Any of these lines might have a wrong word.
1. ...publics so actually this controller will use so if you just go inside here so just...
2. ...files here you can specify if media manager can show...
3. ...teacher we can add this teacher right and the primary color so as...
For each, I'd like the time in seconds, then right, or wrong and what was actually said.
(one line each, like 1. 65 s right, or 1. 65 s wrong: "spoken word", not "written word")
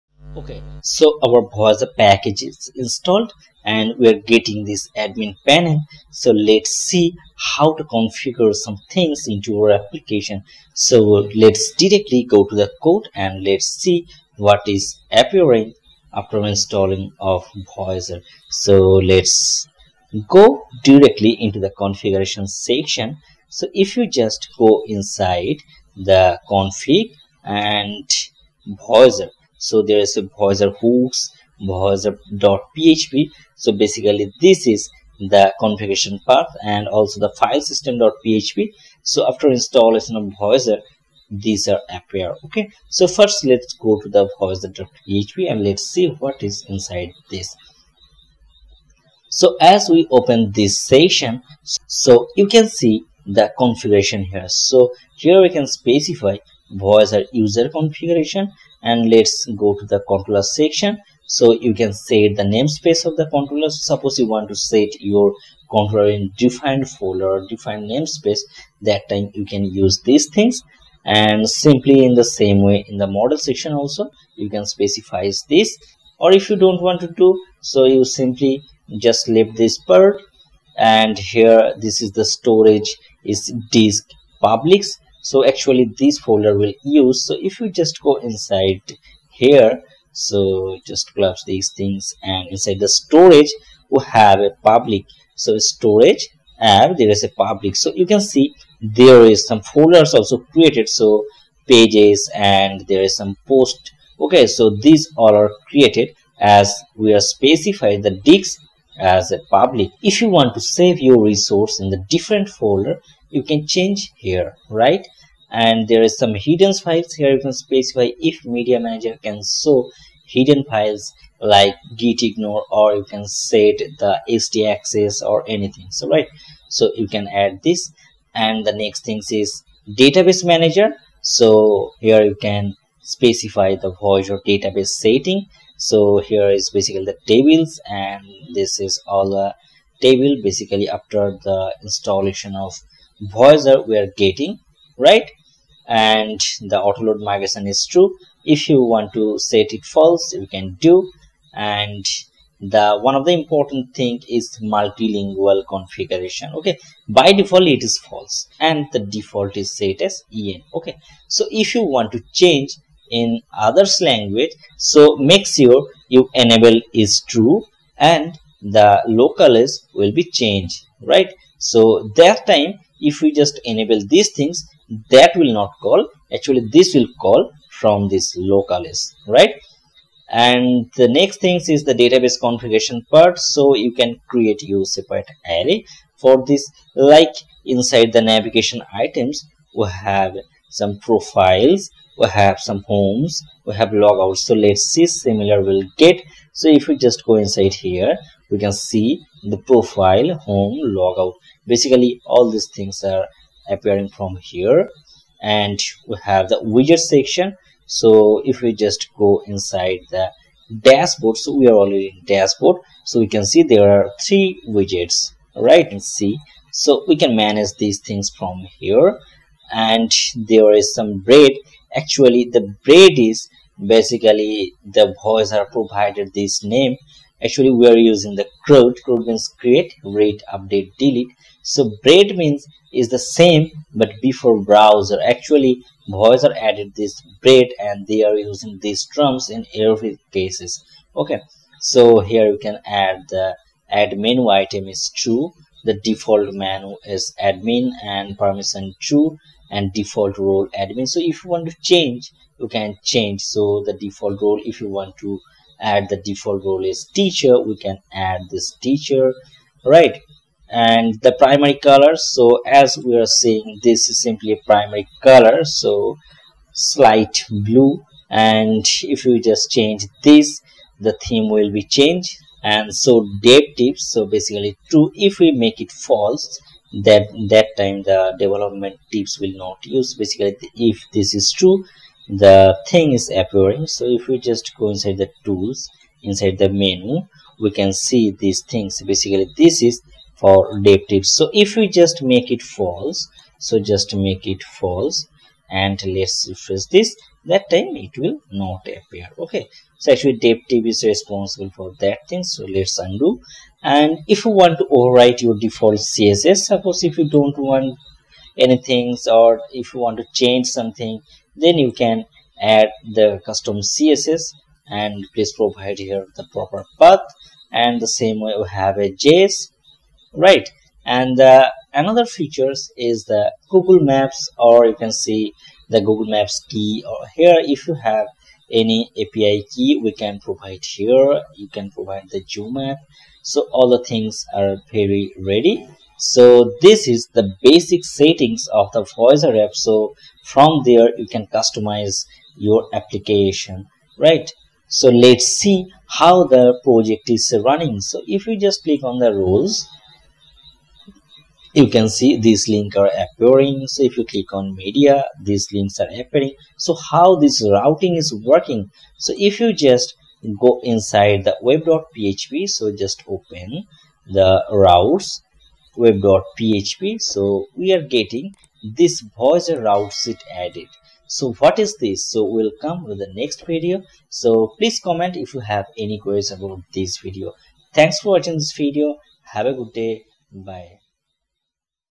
1. 84 s wrong: "folder", not "controller"
2. 116 s right
3. 257 s right.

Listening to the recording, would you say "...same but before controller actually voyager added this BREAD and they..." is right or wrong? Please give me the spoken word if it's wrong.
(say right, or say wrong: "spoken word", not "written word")
wrong: "voyager", not "controller".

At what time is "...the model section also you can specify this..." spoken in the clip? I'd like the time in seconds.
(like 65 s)
72 s.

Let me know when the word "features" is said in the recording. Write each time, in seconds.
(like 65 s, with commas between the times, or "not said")
322 s.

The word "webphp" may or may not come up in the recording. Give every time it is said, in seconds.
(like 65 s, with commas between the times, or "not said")
361 s, 365 s.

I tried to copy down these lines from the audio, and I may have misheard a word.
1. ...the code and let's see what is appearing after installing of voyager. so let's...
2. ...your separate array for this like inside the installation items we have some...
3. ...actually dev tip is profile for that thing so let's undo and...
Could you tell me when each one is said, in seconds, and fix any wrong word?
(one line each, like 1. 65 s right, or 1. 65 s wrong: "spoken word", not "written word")
1. 12 s right
2. 184 s wrong: "navigation", not "installation"
3. 300 s wrong: "responsible", not "profile".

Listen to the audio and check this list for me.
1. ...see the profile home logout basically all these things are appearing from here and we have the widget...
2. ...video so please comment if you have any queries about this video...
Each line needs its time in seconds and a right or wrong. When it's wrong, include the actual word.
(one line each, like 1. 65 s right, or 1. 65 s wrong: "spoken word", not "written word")
1. 198 s right
2. 373 s right.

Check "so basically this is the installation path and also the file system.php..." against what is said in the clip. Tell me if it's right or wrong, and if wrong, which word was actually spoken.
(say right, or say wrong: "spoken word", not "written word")
wrong: "configuration", not "installation".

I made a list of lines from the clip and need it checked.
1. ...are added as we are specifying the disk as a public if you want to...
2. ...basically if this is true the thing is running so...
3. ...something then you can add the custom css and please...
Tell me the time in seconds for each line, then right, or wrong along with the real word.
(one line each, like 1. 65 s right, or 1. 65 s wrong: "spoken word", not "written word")
1. 105 s wrong: "created", not "added"
2. 280 s wrong: "appearing", not "running"
3. 310 s right.